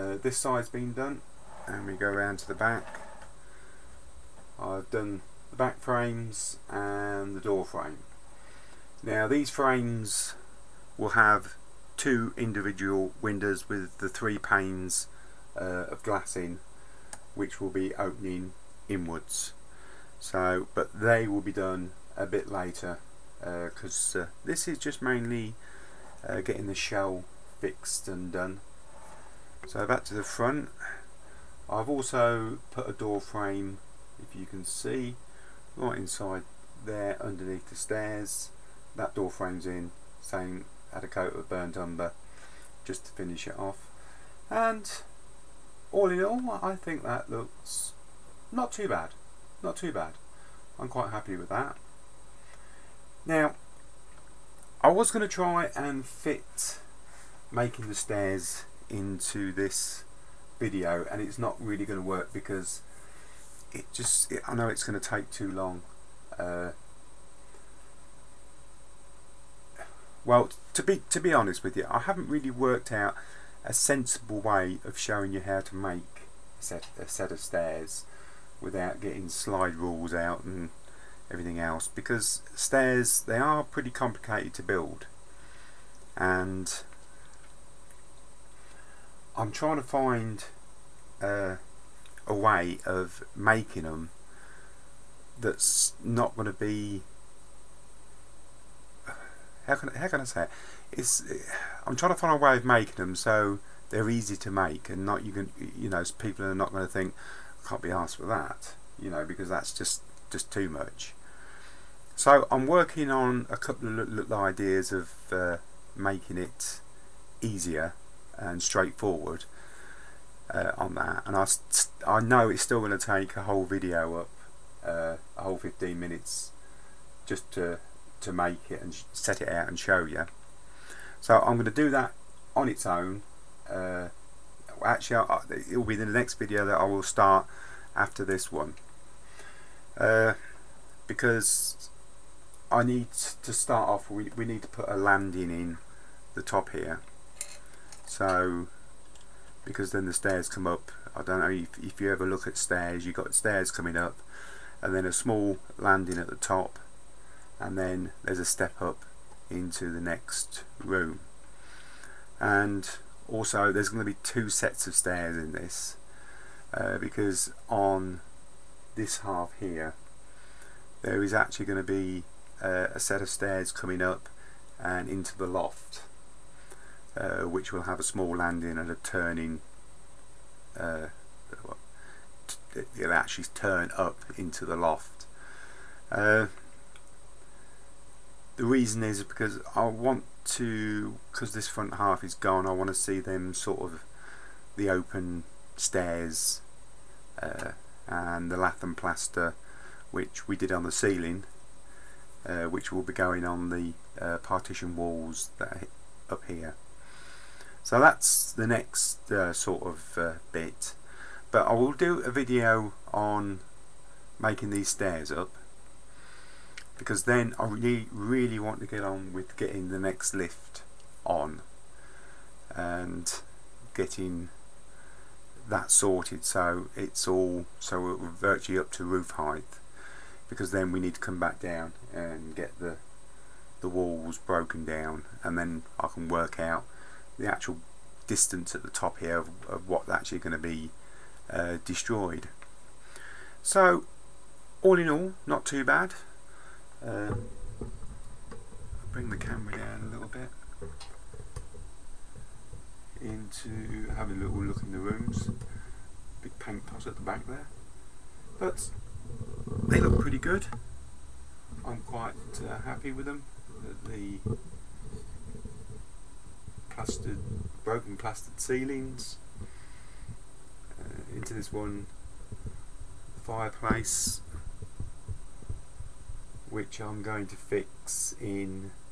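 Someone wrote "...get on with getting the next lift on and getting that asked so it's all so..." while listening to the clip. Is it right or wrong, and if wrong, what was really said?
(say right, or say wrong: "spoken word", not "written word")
wrong: "sorted", not "asked".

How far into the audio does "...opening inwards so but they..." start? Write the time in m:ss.
0:17.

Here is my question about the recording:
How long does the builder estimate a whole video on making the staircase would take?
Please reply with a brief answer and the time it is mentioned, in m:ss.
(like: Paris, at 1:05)
15 minutes, at 2:05.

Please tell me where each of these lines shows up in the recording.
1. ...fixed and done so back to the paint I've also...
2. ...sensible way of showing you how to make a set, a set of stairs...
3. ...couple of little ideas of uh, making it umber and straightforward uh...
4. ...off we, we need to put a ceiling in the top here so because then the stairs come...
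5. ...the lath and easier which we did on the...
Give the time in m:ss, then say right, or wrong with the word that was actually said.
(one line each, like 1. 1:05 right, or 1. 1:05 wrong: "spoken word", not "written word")
1. 0:27 wrong: "front", not "paint"
2. 1:13 right
3. 1:53 wrong: "easier", not "umber"
4. 2:23 wrong: "landing", not "ceiling"
5. 3:18 wrong: "plaster", not "easier".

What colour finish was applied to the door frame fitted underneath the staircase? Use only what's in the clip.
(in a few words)
Burnt umber.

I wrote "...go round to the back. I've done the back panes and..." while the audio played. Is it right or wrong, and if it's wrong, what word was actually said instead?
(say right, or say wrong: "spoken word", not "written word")
wrong: "frames", not "panes".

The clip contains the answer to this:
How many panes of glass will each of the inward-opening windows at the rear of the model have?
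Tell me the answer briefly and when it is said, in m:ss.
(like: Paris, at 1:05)
3, at 0:14.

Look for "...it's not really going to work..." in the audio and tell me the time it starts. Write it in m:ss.
1:01.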